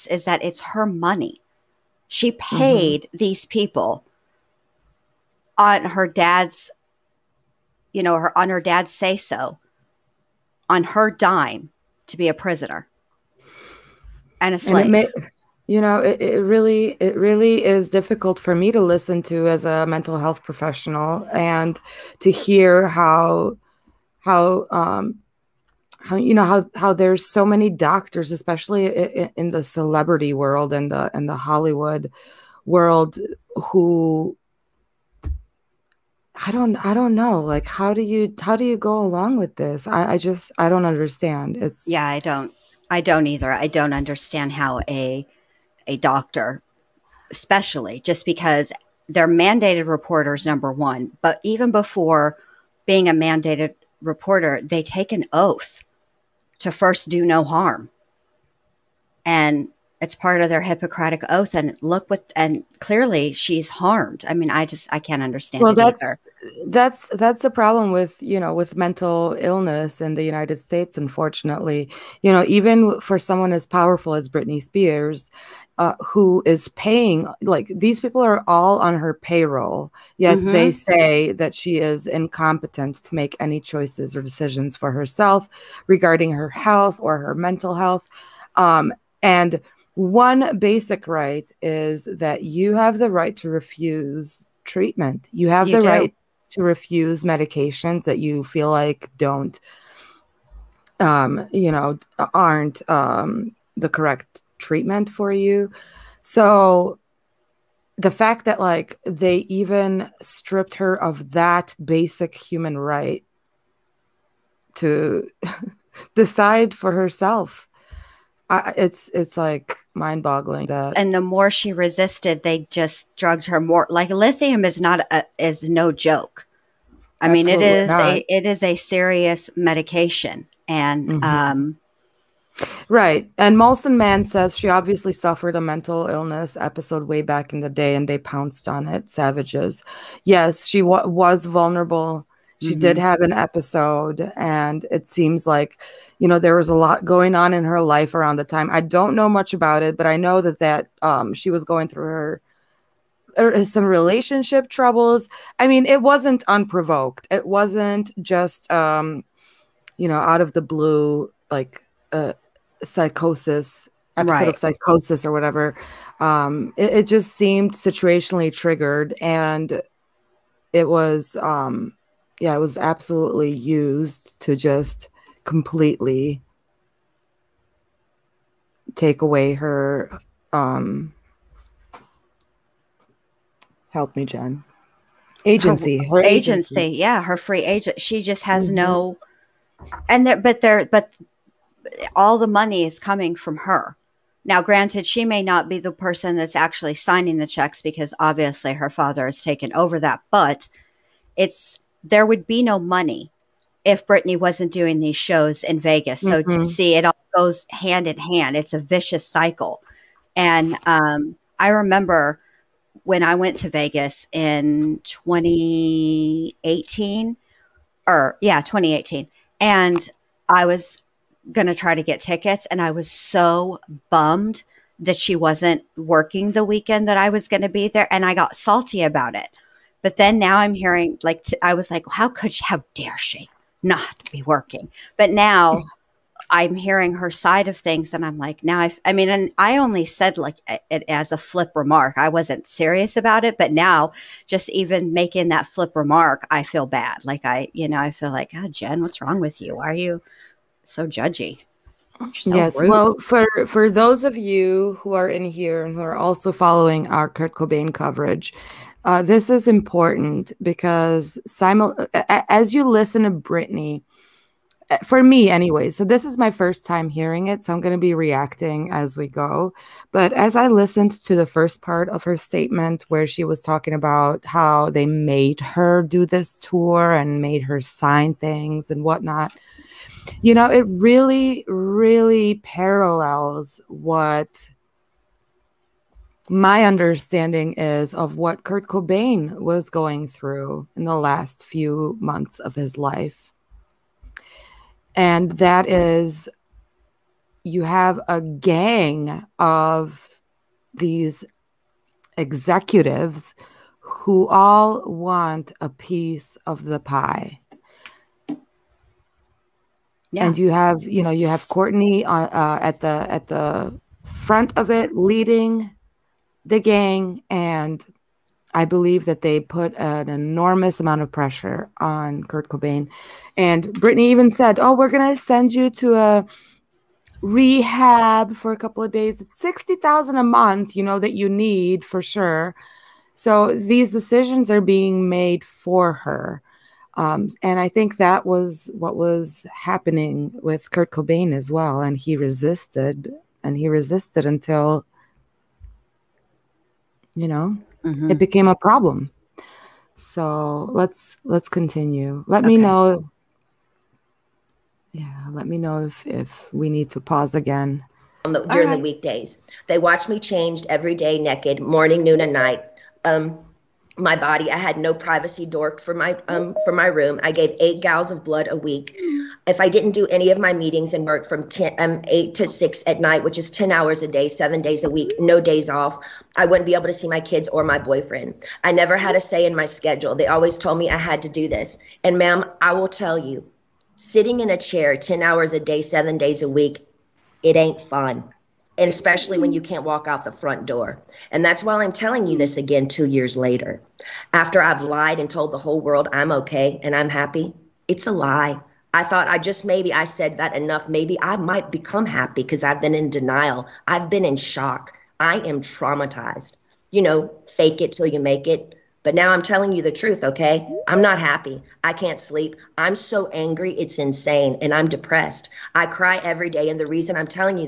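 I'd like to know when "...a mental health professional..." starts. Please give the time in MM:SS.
00:19.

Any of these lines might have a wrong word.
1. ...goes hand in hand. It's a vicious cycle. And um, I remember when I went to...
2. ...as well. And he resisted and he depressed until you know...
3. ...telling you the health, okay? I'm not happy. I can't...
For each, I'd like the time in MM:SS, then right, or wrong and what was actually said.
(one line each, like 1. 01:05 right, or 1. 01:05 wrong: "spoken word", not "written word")
1. 03:27 right
2. 05:41 wrong: "resisted", not "depressed"
3. 06:49 wrong: "truth", not "health".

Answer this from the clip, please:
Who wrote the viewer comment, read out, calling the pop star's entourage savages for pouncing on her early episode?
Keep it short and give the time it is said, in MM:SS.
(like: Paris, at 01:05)
Molson Mann, at 02:13.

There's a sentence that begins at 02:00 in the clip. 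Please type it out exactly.
And the more she resisted, they just drugged her more.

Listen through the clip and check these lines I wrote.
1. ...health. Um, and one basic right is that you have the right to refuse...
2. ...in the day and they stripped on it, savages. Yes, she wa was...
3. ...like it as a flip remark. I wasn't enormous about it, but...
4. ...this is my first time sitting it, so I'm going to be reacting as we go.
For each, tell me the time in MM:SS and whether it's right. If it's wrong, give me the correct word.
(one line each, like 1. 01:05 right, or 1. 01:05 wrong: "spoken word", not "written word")
1. 01:27 right
2. 02:17 wrong: "pounced", not "stripped"
3. 04:00 wrong: "serious", not "enormous"
4. 04:26 wrong: "hearing", not "sitting".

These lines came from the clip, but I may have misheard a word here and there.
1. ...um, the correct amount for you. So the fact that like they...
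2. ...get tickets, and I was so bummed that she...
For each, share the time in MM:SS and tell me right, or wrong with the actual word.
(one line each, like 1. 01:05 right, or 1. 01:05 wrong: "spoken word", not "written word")
1. 01:42 wrong: "treatment", not "amount"
2. 03:42 right.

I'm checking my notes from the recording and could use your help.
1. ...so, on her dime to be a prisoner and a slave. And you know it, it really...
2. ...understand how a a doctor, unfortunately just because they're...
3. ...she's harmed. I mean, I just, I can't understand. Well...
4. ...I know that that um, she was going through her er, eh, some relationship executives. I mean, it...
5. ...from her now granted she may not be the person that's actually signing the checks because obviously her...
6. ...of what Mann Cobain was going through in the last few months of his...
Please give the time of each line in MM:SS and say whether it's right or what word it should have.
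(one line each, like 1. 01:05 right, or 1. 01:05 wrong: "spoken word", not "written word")
1. 00:09 right
2. 00:43 wrong: "especially", not "unfortunately"
3. 01:03 right
4. 02:30 wrong: "troubles", not "executives"
5. 03:13 right
6. 04:48 wrong: "Kurt", not "Mann".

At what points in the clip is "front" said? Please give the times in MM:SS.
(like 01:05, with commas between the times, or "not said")
05:14, 06:30.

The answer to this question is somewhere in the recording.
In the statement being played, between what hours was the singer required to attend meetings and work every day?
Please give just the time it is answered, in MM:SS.
06:12.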